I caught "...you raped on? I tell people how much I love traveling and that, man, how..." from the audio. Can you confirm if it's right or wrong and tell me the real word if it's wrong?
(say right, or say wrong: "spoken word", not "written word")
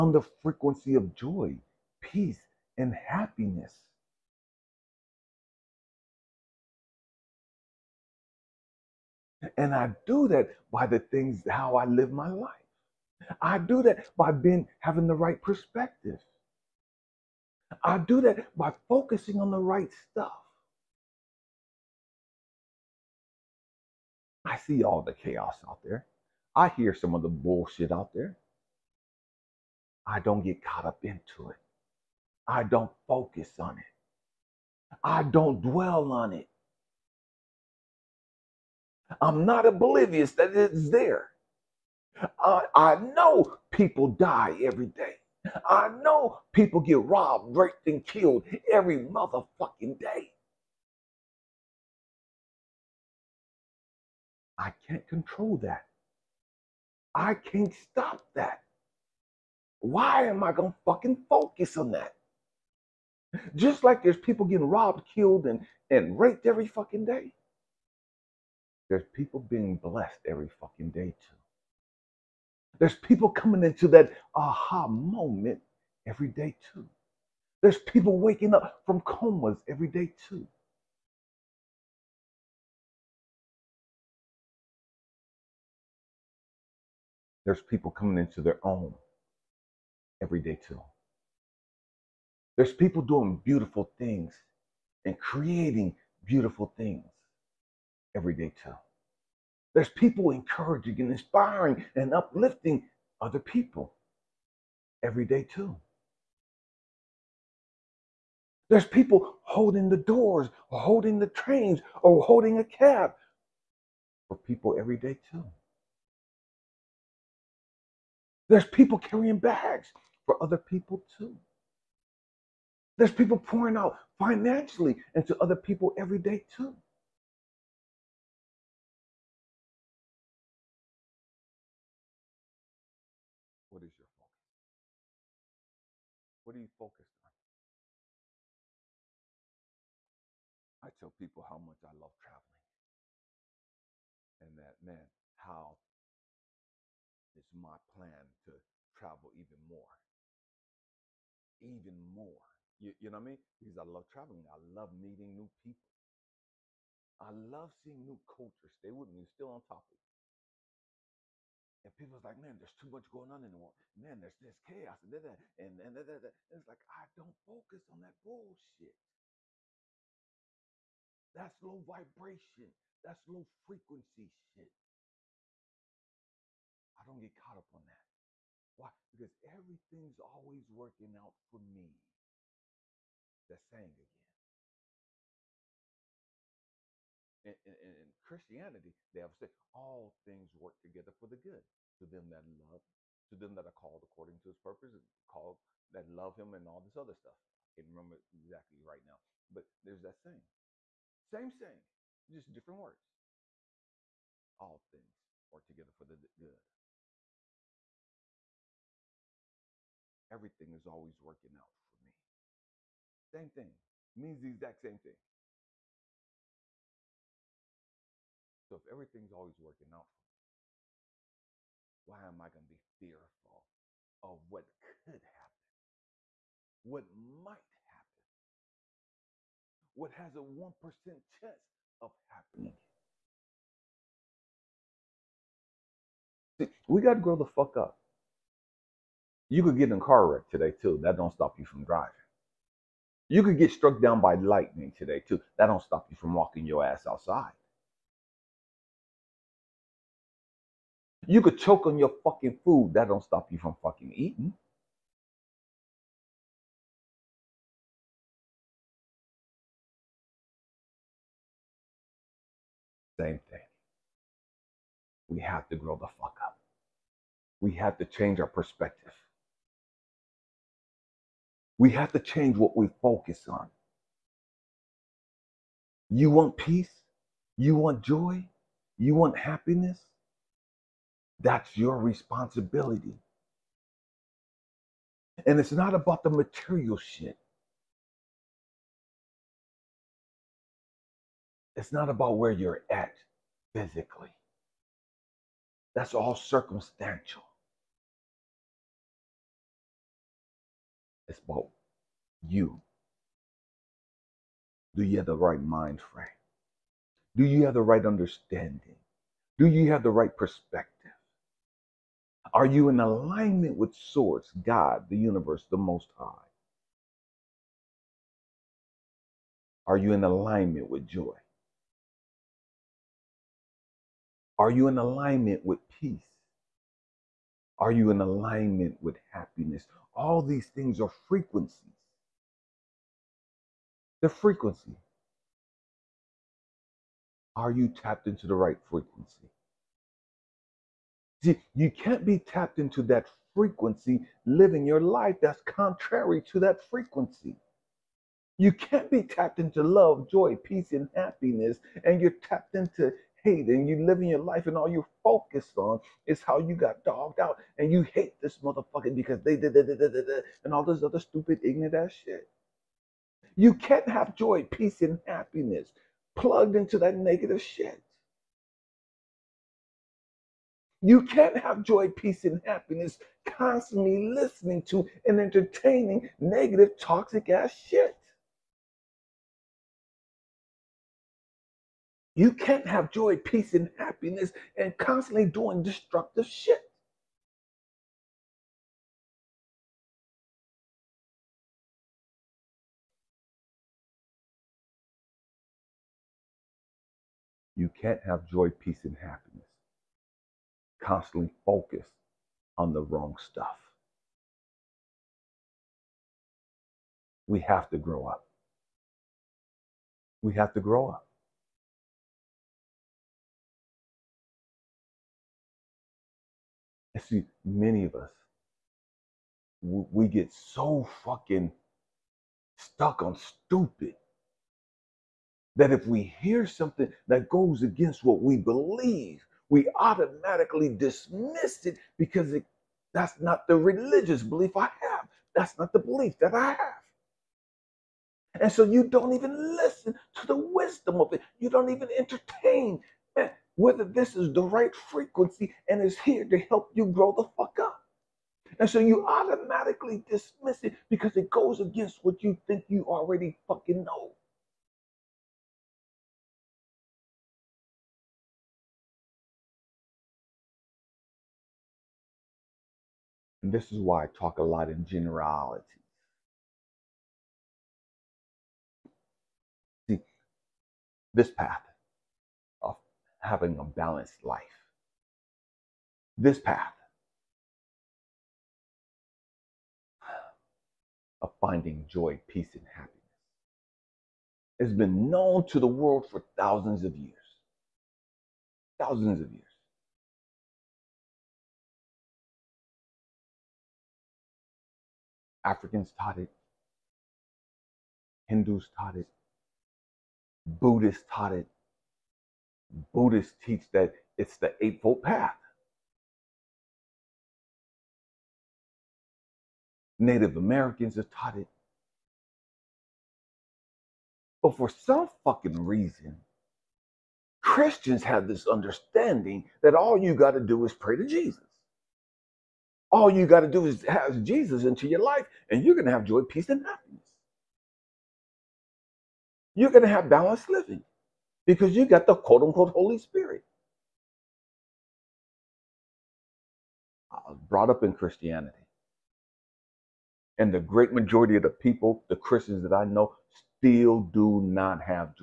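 wrong: "focused", not "raped".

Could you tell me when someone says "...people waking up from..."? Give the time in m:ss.
1:17.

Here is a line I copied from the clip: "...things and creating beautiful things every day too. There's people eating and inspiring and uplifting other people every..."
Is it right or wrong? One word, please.
wrong.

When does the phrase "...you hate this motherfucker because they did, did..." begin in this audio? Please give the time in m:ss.
5:57.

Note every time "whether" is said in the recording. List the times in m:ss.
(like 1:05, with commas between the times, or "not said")
7:23.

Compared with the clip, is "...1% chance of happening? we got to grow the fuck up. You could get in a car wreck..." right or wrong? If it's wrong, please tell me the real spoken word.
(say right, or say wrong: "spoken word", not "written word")
right.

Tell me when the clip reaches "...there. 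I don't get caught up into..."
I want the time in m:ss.
0:28.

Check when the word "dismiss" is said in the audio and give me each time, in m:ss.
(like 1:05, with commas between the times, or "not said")
7:10, 7:30.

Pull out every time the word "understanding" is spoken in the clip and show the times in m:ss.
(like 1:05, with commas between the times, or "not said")
5:08, 8:38.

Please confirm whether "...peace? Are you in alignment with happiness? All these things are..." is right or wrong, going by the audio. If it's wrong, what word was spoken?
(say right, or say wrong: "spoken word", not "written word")
right.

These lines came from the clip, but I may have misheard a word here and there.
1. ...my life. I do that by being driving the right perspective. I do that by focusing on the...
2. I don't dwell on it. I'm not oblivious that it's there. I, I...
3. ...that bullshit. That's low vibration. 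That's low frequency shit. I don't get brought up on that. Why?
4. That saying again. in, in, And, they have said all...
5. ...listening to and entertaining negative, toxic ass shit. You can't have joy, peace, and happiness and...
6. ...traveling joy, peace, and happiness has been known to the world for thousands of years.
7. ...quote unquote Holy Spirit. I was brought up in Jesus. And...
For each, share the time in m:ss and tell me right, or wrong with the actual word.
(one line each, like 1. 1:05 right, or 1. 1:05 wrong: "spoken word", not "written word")
1. 0:12 wrong: "having", not "driving"
2. 0:35 right
3. 2:48 wrong: "caught", not "brought"
4. 3:03 wrong: "Christianity", not "And"
5. 6:14 right
6. 8:01 wrong: "finding", not "traveling"
7. 8:52 wrong: "Christianity", not "Jesus".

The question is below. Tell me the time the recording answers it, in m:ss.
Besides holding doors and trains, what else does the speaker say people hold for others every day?
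1:52.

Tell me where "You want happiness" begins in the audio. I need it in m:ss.
4:38.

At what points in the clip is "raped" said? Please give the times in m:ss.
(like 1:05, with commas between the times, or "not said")
0:47, 1:06.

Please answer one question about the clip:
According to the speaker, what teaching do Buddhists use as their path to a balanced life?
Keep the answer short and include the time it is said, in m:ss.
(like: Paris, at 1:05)
the Eightfold Path, at 8:24.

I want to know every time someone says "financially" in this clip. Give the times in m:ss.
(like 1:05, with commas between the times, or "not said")
2:04.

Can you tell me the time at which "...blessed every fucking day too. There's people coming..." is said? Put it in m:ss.
1:09.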